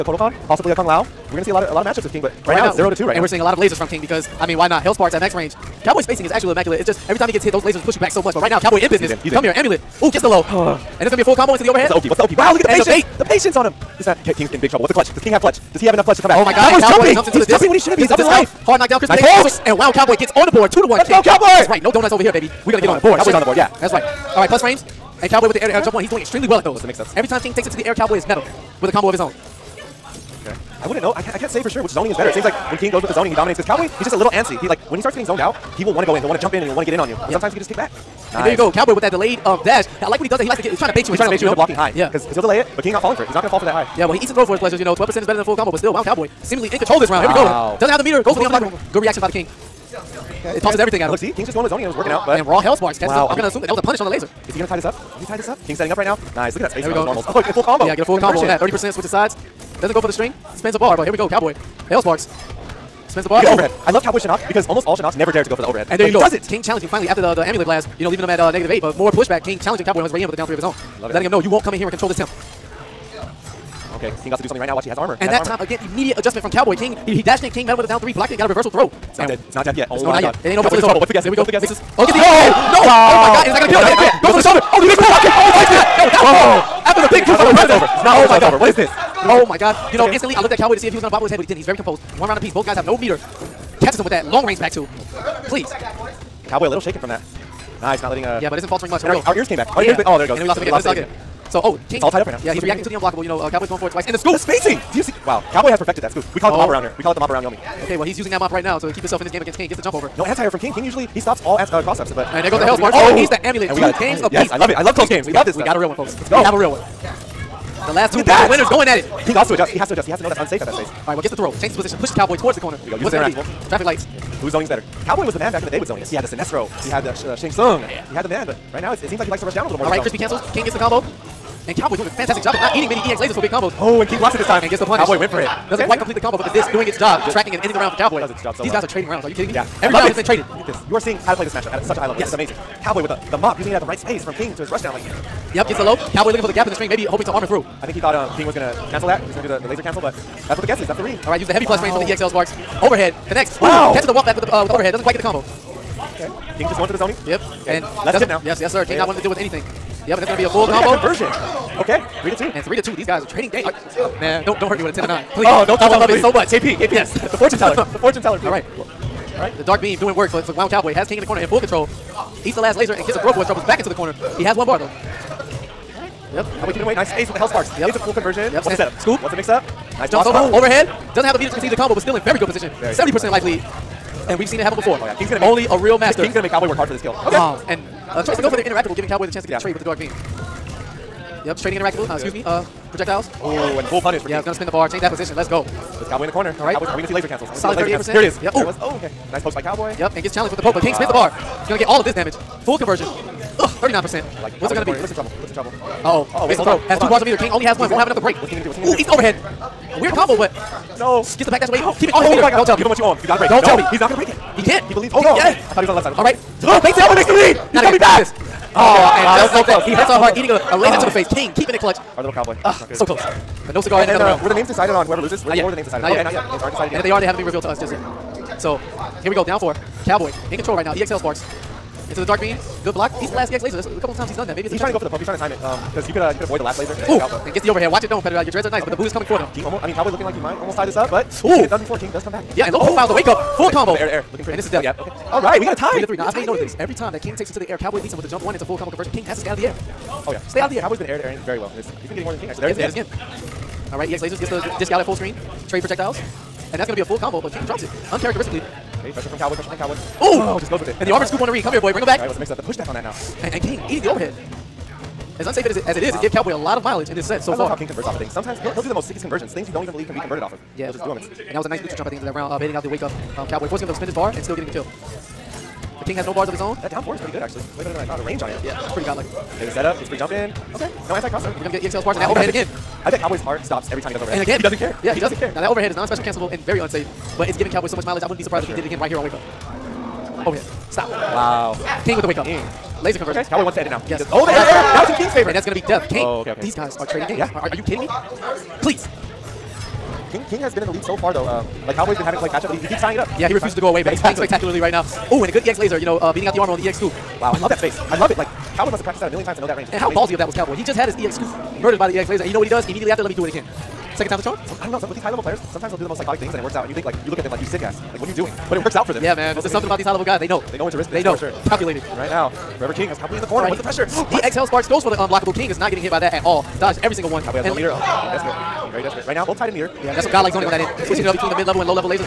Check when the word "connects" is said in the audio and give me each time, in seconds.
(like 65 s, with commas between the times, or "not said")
153 s.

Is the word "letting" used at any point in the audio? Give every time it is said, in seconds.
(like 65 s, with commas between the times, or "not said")
71 s, 98 s.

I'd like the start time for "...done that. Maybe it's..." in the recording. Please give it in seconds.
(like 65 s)
234 s.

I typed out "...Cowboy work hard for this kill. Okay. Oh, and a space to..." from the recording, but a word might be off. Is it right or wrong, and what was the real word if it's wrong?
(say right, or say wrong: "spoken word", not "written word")
wrong: "choice", not "space".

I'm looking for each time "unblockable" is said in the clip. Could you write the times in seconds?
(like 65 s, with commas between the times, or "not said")
48 s, 102 s, 325 s.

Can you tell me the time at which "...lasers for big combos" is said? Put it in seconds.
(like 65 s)
133 s.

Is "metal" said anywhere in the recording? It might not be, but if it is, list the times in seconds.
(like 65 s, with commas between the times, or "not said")
28 s.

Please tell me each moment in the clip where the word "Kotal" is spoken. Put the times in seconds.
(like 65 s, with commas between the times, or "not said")
0 s.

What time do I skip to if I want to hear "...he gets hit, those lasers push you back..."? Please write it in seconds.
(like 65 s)
7 s.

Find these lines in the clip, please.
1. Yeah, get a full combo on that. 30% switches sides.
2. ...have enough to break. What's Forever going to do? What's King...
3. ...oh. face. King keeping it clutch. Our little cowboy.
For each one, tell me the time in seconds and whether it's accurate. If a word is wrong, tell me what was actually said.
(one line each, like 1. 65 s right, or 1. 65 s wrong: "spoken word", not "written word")
1. 57 s right
2. 207 s wrong: "King", not "Forever"
3. 221 s right.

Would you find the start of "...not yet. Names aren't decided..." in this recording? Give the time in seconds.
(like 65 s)
226 s.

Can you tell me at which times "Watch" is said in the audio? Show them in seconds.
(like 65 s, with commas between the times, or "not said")
74 s, 237 s.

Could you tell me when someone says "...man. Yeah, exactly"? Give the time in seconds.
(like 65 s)
304 s.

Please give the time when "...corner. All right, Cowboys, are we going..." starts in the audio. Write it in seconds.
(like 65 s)
196 s.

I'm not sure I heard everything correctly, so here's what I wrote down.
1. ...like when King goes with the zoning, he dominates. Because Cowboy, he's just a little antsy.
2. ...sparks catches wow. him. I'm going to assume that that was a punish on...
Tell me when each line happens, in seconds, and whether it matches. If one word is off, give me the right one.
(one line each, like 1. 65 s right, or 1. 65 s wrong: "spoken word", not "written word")
1. 32 s right
2. 52 s right.